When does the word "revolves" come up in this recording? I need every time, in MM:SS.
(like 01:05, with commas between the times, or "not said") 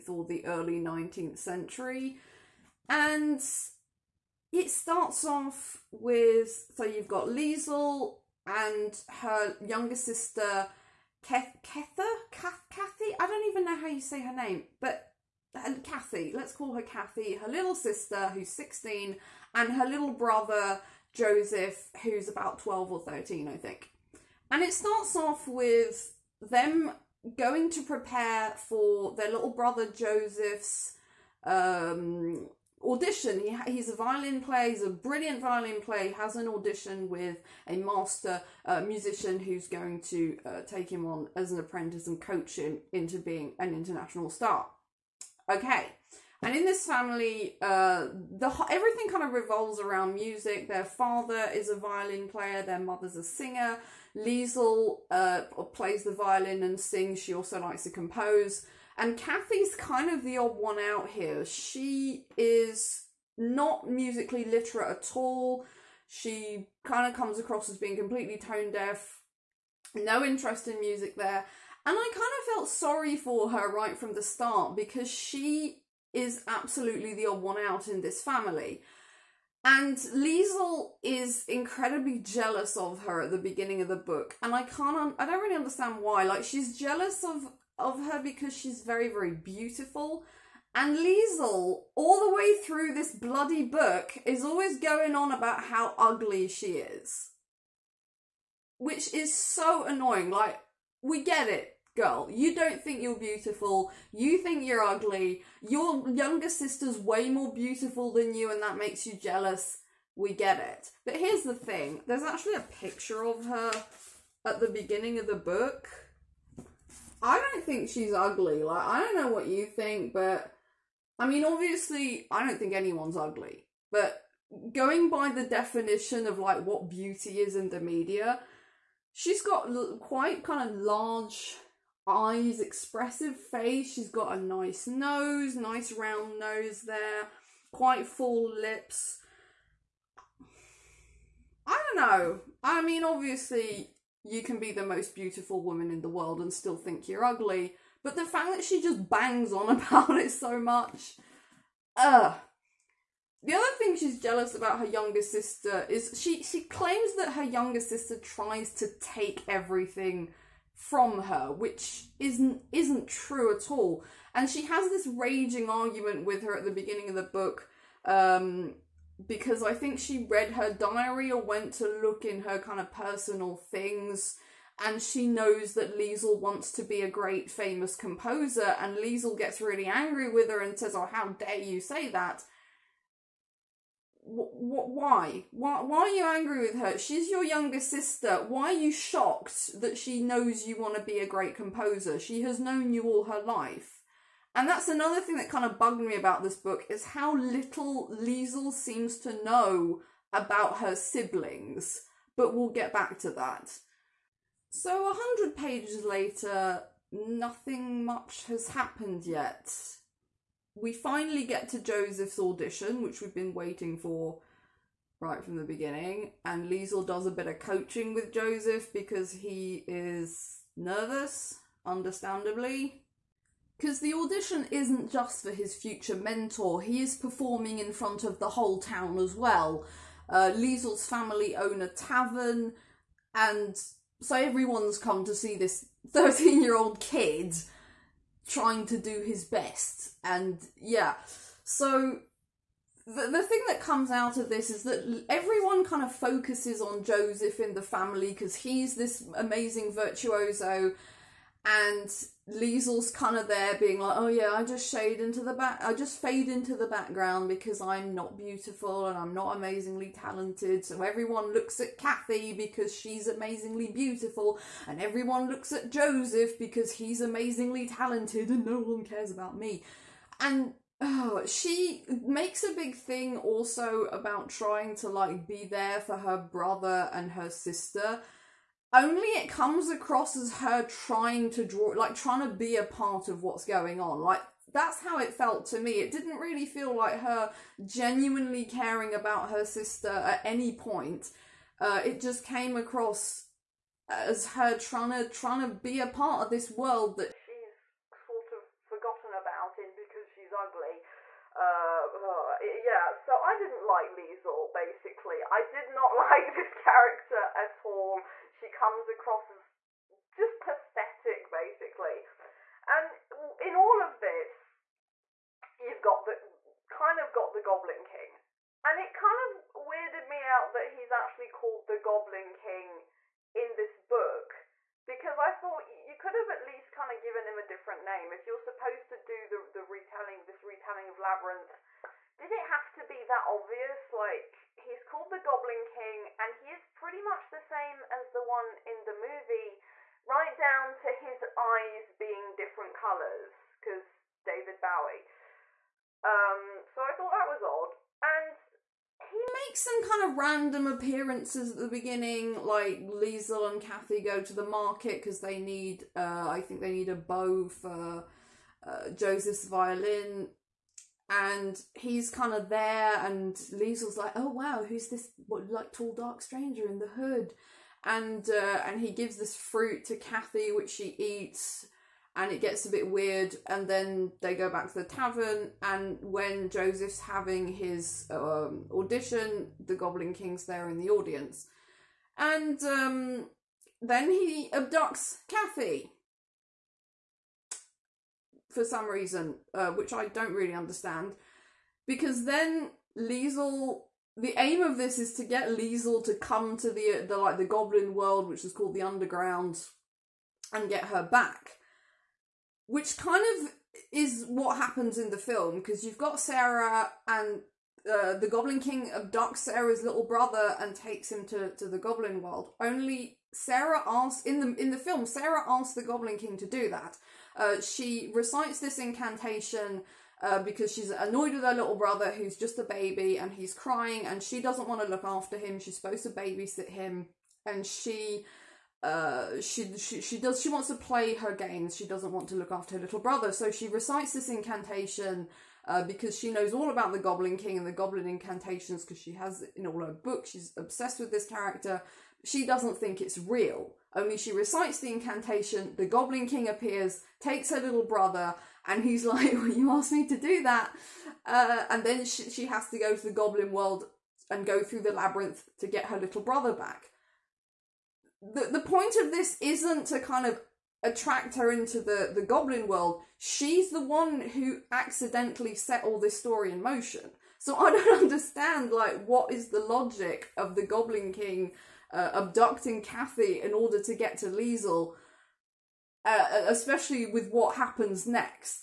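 00:49.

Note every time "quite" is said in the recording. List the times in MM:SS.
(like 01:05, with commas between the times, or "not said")
02:10, 02:17.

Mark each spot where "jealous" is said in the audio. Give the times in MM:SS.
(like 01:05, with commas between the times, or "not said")
01:22, 01:26, 01:49, 02:34.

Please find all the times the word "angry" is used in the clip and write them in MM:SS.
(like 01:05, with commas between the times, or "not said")
02:59, 03:06.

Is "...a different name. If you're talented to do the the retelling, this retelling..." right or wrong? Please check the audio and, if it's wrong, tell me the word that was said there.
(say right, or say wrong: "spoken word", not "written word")
wrong: "supposed", not "talented".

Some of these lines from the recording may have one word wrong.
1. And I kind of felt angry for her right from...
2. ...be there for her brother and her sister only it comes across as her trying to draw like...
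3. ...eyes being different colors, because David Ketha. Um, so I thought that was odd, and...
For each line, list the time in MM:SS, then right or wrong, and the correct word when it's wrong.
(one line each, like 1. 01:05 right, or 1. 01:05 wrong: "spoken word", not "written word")
1. 01:11 wrong: "sorry", not "angry"
2. 04:35 right
3. 05:41 wrong: "Bowie", not "Ketha".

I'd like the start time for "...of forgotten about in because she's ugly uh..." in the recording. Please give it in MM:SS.
04:58.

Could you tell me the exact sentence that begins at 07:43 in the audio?
She's the one who accidentally set all this story in motion.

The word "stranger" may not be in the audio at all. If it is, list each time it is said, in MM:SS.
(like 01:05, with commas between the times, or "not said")
06:06.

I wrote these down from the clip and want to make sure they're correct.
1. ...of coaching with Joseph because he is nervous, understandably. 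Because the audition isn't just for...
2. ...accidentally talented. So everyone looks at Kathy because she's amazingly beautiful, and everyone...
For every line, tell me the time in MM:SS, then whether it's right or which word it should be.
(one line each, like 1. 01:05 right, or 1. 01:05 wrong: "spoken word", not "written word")
1. 03:37 right
2. 04:19 wrong: "amazingly", not "accidentally".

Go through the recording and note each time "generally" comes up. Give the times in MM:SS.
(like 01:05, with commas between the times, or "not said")
not said.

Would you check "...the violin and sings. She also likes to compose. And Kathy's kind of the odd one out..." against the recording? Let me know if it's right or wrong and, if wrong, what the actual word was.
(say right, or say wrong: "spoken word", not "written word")
right.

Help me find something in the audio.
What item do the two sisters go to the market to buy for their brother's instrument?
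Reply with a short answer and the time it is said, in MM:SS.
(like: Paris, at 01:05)
A bow, at 05:57.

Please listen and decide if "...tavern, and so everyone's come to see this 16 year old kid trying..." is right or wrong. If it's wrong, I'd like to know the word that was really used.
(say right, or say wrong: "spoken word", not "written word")
wrong: "13", not "16".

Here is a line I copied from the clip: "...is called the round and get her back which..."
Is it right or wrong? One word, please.
wrong.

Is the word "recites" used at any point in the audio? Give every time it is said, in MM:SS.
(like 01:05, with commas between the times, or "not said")
06:58, 07:13, 07:24.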